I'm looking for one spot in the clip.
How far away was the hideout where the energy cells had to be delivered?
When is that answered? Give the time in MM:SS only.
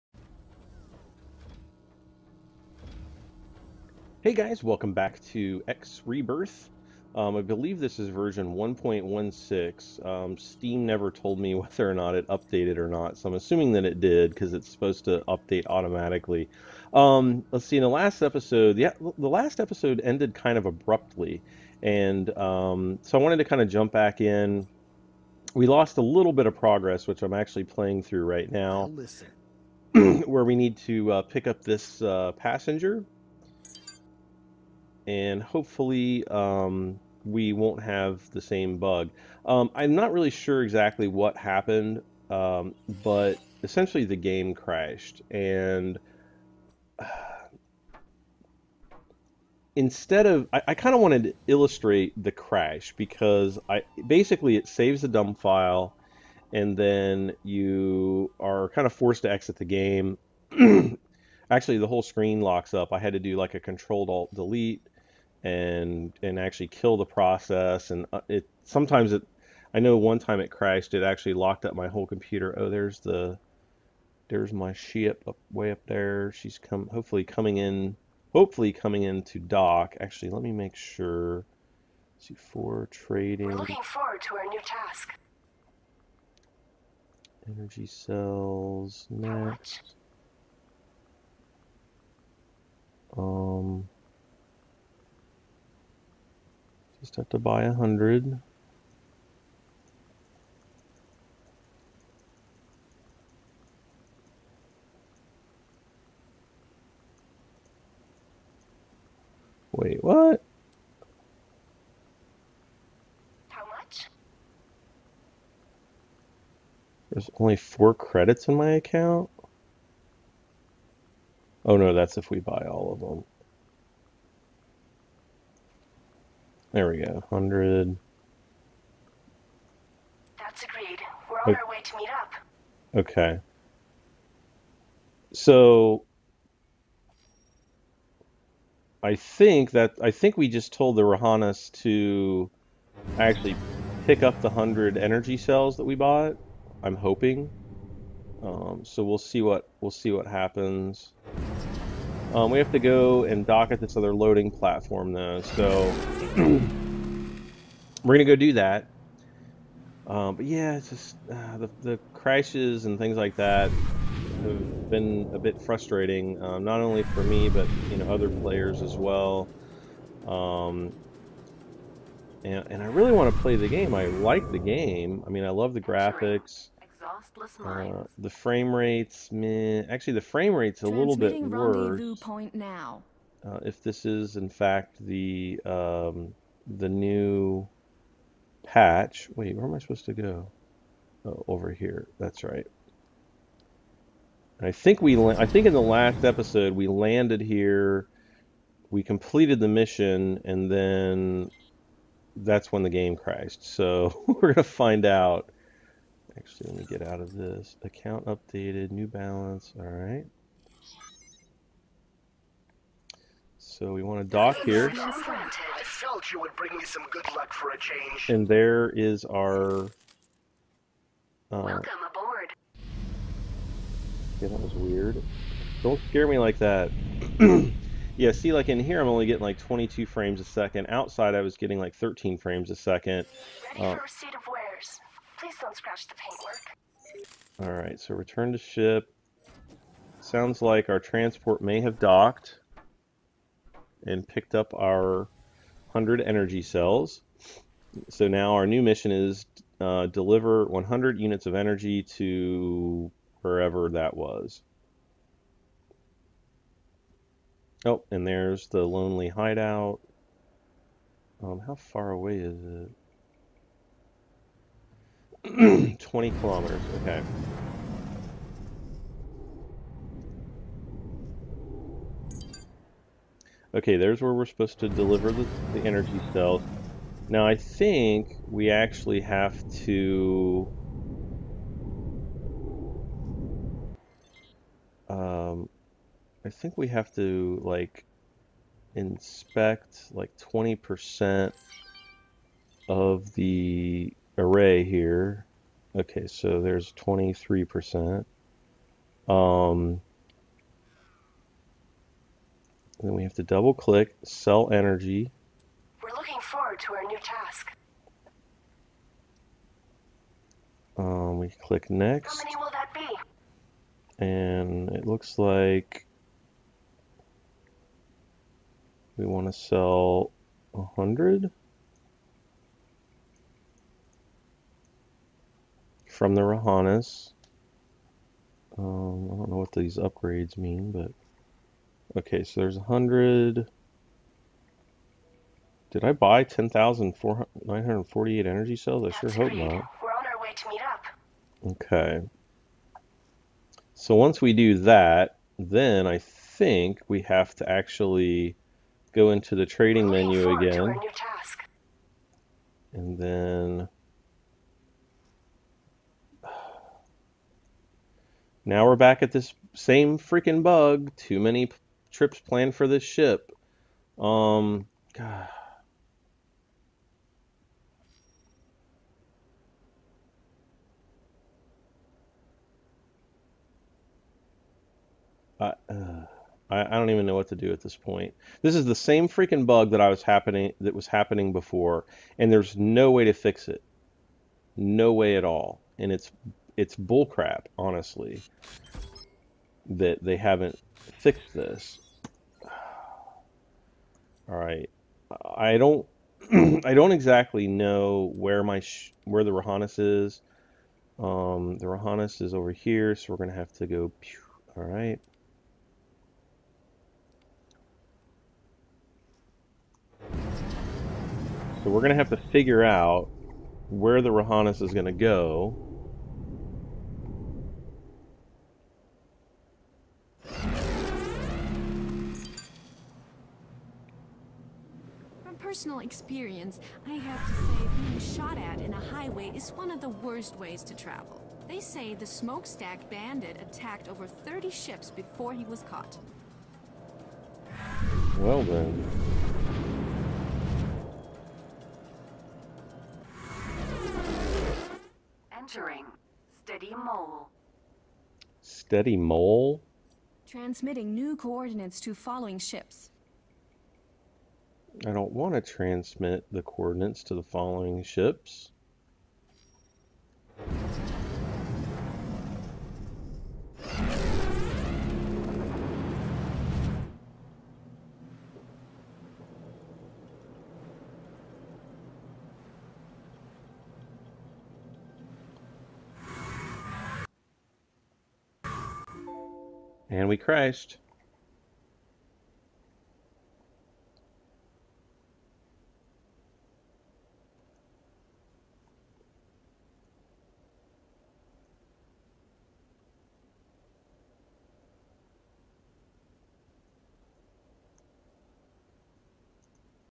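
04:25.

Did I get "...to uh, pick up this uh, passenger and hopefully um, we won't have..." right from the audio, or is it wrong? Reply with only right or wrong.
right.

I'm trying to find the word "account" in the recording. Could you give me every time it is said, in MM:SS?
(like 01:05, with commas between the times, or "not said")
01:58, 03:27.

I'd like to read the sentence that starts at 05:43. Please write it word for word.
So once we do that, then I think we have to actually go into the trading menu again.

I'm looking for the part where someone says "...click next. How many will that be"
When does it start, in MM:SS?
05:11.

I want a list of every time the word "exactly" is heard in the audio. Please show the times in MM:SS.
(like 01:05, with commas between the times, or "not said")
00:40, 06:37.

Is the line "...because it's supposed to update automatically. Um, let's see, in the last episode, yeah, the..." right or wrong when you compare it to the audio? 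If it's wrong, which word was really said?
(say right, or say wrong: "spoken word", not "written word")
right.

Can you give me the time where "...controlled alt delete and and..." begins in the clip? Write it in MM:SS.
01:03.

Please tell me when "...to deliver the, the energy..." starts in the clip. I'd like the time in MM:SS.
04:34.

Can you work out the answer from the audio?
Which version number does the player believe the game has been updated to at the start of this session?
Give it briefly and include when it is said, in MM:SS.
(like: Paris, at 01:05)
1.16, at 00:08.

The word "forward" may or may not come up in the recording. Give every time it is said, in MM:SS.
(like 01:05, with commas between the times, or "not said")
01:23, 05:06.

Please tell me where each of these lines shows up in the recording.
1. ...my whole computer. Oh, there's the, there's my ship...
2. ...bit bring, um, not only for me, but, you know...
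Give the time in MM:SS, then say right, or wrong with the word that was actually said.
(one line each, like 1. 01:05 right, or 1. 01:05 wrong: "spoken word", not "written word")
1. 01:11 right
2. 02:45 wrong: "frustrating", not "bring".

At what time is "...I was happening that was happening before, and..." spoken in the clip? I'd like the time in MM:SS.
06:20.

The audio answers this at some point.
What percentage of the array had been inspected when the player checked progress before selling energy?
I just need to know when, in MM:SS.
04:56.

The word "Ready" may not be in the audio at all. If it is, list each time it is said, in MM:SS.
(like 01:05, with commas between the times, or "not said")
03:53.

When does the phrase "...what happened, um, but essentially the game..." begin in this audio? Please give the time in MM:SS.
00:41.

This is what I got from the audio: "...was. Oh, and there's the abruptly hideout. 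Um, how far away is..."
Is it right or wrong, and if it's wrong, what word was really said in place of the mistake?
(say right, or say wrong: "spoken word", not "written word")
wrong: "lonely", not "abruptly".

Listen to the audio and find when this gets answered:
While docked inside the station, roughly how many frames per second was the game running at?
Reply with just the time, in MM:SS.
03:49.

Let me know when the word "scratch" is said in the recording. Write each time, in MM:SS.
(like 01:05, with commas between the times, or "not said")
03:55.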